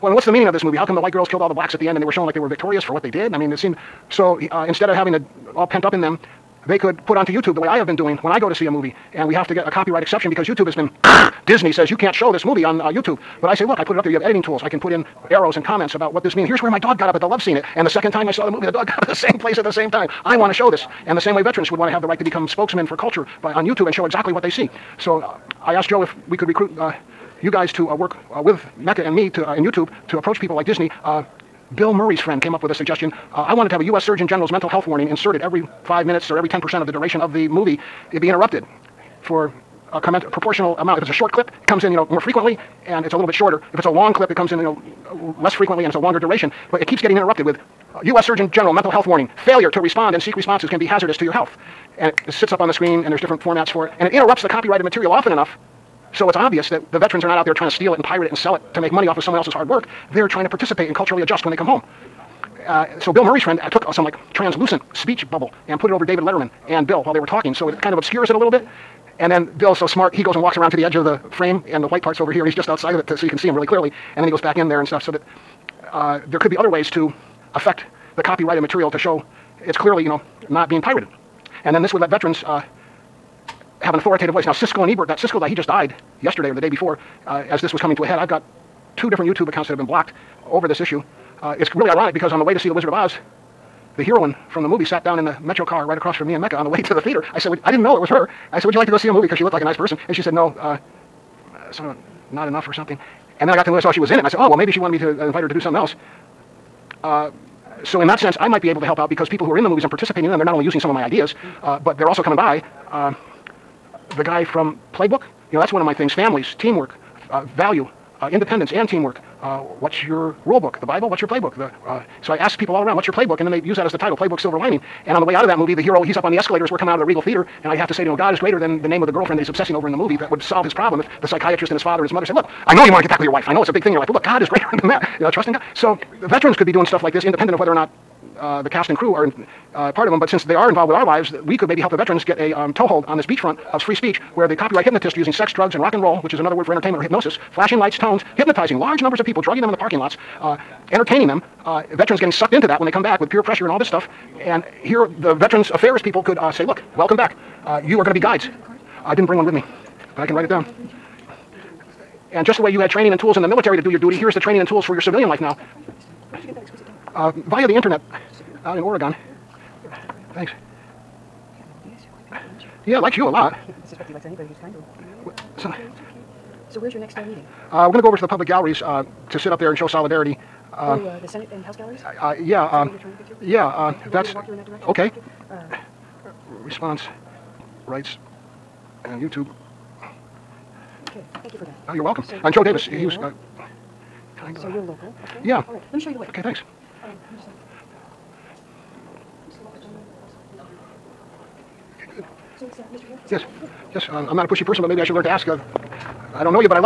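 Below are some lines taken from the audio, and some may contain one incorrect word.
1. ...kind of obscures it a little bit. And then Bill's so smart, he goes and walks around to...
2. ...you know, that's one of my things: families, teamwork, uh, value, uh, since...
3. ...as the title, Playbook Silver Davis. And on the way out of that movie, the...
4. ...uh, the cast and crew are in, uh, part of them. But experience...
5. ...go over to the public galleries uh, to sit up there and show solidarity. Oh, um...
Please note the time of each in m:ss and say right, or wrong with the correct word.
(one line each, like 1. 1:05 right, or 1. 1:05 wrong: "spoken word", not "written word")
1. 1:07 right
2. 1:55 wrong: "independence", not "since"
3. 2:03 wrong: "Lining", not "Davis"
4. 2:18 wrong: "since", not "experience"
5. 2:58 right.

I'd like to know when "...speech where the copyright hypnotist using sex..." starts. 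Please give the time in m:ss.
2:23.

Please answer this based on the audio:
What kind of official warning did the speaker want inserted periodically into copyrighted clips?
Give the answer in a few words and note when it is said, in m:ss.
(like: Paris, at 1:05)
U.S. Surgeon General's mental health warning, at 0:33.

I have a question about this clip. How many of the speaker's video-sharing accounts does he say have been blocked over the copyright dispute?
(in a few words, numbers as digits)
2.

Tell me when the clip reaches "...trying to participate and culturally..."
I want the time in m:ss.
1:00.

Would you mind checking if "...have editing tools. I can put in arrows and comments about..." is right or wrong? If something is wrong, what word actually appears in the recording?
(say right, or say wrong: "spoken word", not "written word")
right.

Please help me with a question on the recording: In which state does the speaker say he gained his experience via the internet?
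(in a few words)
Oregon.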